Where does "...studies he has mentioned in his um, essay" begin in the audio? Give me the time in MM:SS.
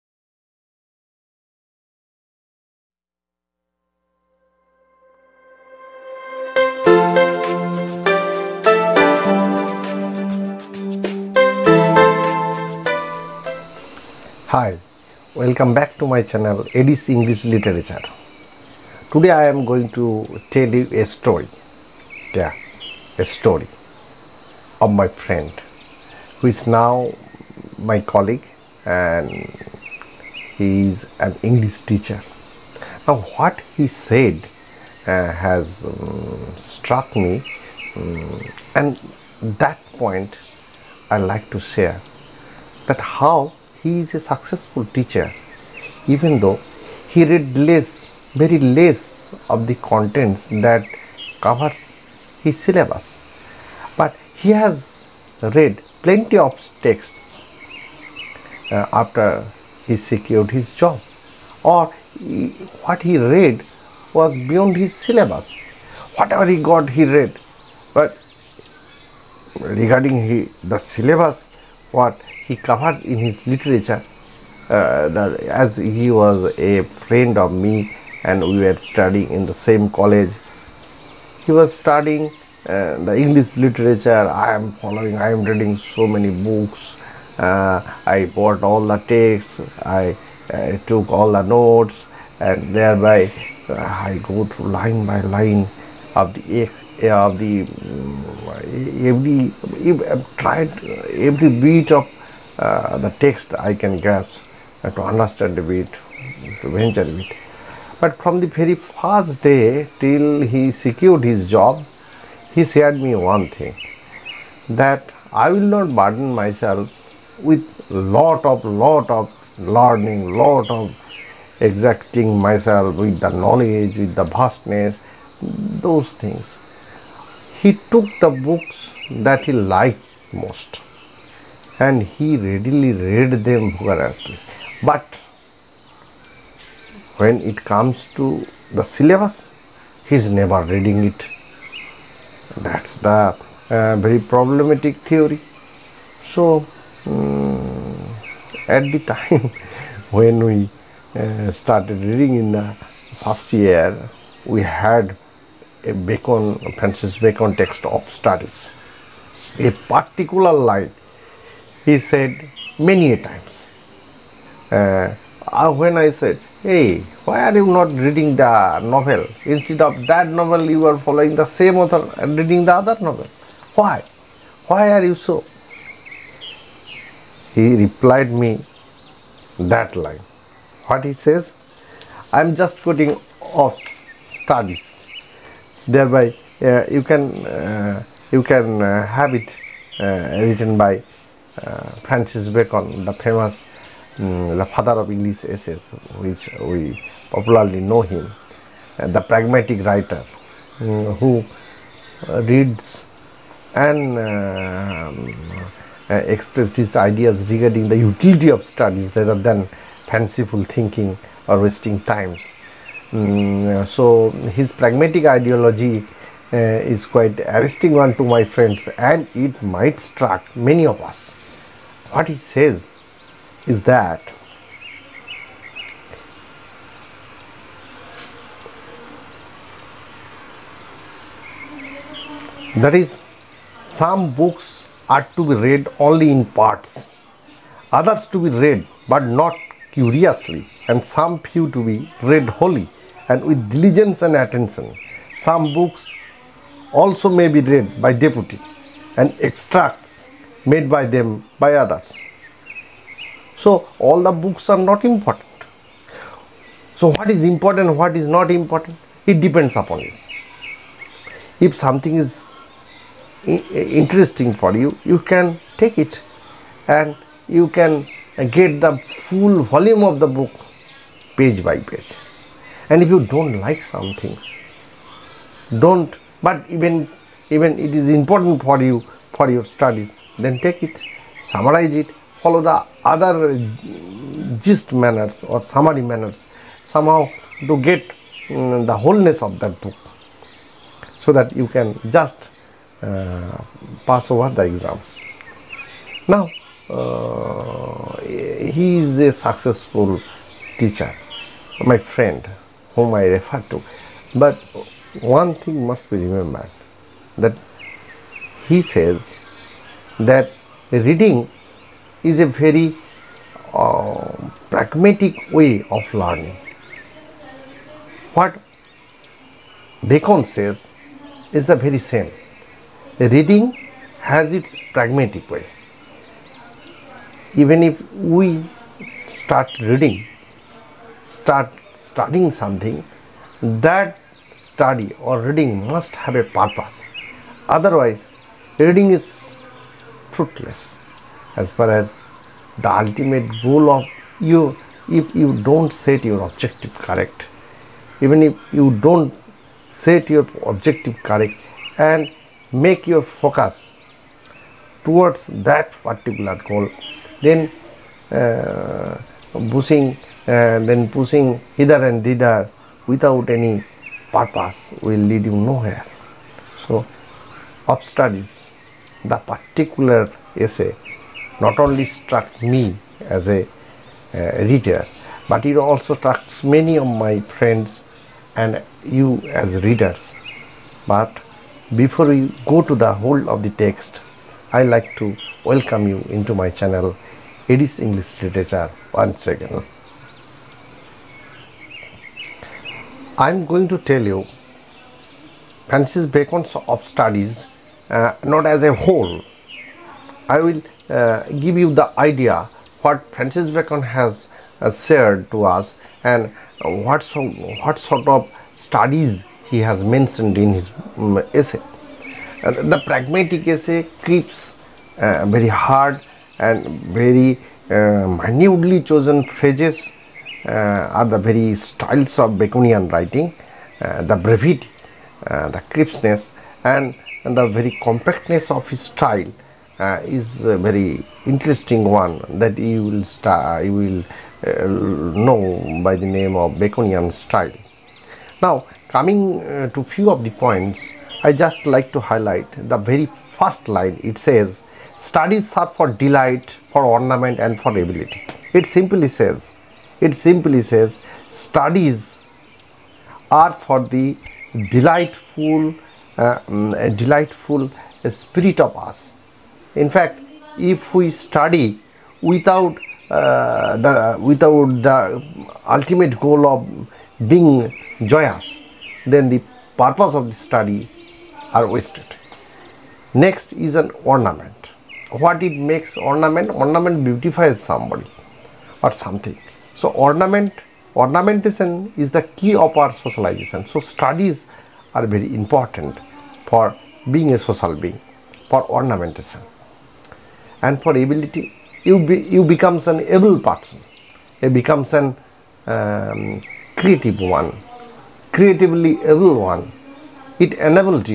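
06:48.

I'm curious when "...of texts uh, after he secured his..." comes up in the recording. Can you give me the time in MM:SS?
00:56.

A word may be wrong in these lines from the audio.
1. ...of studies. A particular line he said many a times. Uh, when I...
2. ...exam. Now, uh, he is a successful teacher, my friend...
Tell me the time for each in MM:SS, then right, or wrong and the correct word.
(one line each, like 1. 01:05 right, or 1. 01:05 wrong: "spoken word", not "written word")
1. 02:37 right
2. 04:54 right.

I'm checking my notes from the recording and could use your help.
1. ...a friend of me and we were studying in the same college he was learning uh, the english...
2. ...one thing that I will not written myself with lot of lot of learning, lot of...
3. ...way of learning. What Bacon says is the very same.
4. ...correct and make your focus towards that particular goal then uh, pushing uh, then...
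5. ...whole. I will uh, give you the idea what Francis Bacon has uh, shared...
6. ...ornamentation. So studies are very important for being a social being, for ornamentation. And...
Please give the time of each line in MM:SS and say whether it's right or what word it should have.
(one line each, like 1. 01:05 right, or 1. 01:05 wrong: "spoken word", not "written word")
1. 01:16 wrong: "studying", not "learning"
2. 01:53 wrong: "burden", not "written"
3. 05:15 right
4. 05:51 right
5. 06:38 right
6. 08:03 wrong: "socialization", not "ornamentation".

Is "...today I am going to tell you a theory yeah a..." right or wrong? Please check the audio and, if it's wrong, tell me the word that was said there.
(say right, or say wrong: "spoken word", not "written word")
wrong: "story", not "theory".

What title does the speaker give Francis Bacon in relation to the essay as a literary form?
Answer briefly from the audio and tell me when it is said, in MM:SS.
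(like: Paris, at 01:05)
father of English essays, at 03:14.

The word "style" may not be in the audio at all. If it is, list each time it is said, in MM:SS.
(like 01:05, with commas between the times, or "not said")
07:01, 07:09, 07:17.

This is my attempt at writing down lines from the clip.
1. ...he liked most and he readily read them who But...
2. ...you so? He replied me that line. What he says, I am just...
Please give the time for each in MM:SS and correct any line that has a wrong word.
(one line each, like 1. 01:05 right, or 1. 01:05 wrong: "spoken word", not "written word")
1. 02:09 right
2. 02:55 right.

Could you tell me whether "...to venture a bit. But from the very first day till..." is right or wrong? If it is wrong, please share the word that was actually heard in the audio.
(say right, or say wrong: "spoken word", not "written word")
right.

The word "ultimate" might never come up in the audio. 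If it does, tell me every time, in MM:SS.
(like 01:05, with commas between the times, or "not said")
05:43, 07:45.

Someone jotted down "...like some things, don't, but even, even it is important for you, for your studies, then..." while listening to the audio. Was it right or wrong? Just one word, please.
right.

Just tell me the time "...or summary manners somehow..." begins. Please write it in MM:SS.
04:45.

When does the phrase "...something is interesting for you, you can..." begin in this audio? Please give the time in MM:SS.
04:21.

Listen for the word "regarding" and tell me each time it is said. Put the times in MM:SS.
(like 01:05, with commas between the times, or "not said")
01:09, 03:27.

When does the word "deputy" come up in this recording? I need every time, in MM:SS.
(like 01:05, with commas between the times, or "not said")
04:08.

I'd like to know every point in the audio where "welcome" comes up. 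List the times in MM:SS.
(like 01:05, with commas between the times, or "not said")
00:15, 06:25.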